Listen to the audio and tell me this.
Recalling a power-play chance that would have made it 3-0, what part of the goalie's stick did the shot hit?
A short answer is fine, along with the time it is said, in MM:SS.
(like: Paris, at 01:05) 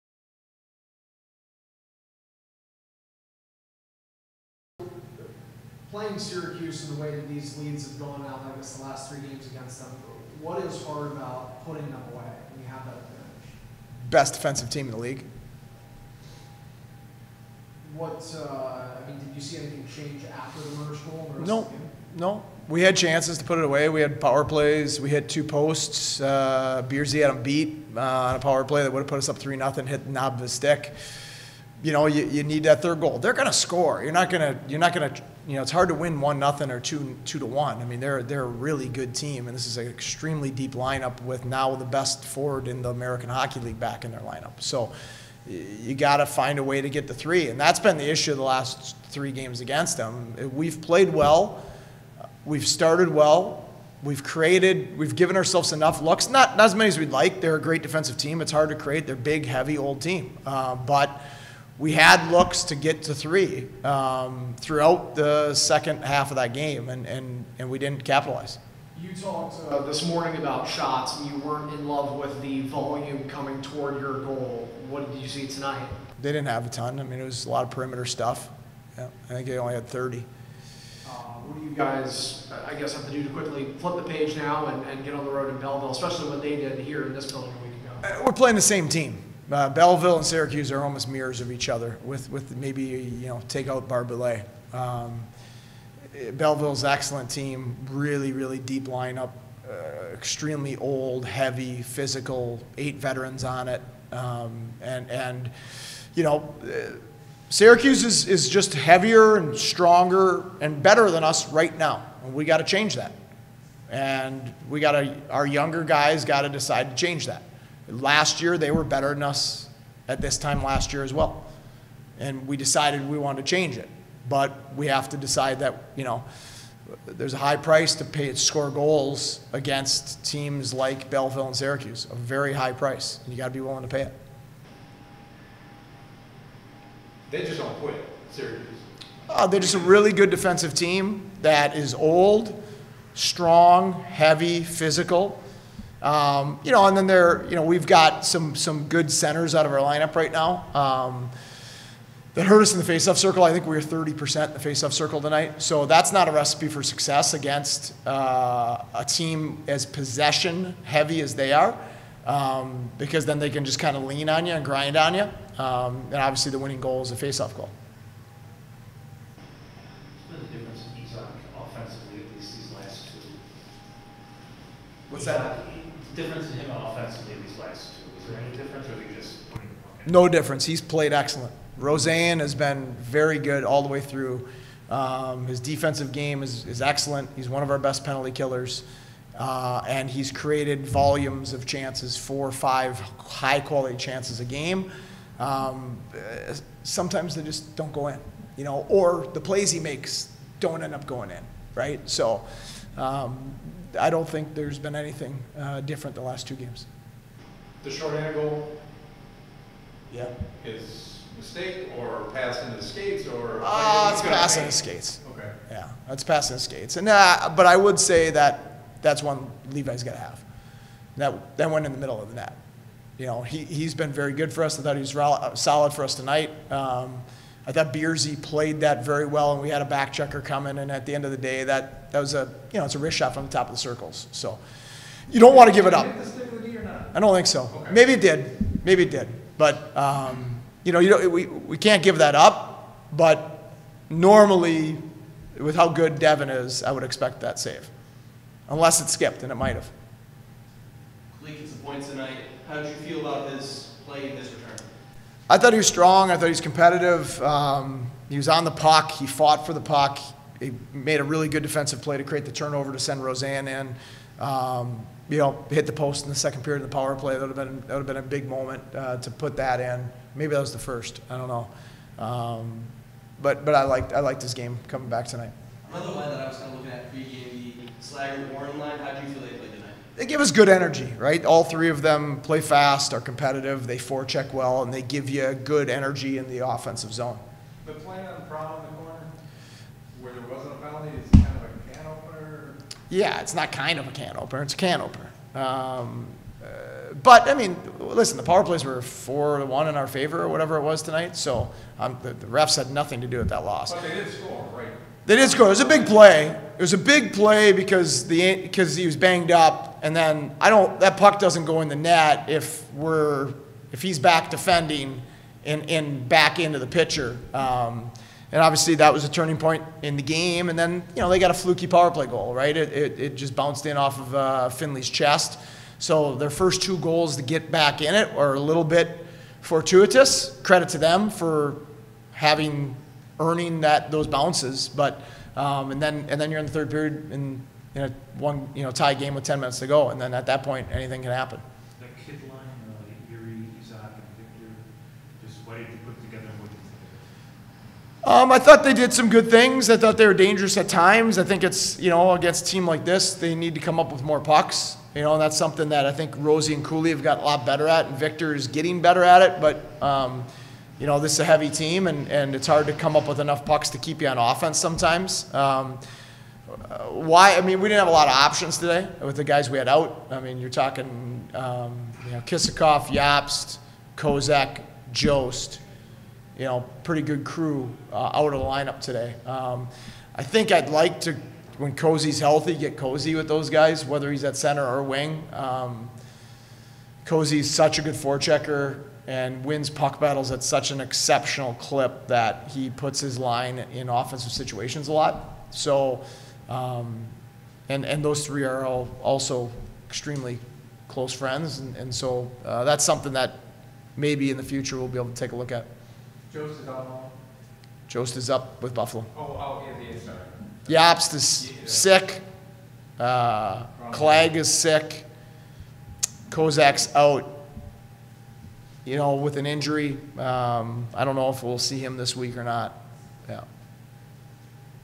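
the knob, at 00:30.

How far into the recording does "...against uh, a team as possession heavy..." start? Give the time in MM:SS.
02:37.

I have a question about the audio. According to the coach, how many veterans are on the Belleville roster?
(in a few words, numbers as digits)
8.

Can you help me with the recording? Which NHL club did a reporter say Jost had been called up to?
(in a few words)
Buffalo.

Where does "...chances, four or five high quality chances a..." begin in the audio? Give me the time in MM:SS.
03:11.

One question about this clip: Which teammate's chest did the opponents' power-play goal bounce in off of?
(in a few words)
Finley.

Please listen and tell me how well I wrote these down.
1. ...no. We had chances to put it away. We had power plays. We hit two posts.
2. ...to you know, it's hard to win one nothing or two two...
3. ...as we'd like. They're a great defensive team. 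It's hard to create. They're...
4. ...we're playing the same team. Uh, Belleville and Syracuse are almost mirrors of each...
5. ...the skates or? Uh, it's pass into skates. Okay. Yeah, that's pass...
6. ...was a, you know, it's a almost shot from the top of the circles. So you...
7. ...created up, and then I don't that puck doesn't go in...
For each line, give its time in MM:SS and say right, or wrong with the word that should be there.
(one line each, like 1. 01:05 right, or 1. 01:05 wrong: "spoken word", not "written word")
1. 00:22 right
2. 00:35 right
3. 00:56 right
4. 01:28 right
5. 03:32 right
6. 03:52 wrong: "wrist", not "almost"
7. 05:09 wrong: "banged", not "created".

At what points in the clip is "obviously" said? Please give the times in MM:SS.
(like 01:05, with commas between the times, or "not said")
02:46, 05:18.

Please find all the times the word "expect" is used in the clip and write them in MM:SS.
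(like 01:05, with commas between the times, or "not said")
04:07.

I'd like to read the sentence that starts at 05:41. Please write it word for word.
That kid line, uh, Erie, Isak, and Viktor, just what did you put together?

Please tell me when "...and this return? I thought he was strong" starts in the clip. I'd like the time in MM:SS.
04:14.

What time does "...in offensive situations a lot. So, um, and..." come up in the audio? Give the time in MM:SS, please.
06:33.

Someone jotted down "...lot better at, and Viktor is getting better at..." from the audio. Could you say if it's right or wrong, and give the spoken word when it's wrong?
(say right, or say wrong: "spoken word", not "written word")
right.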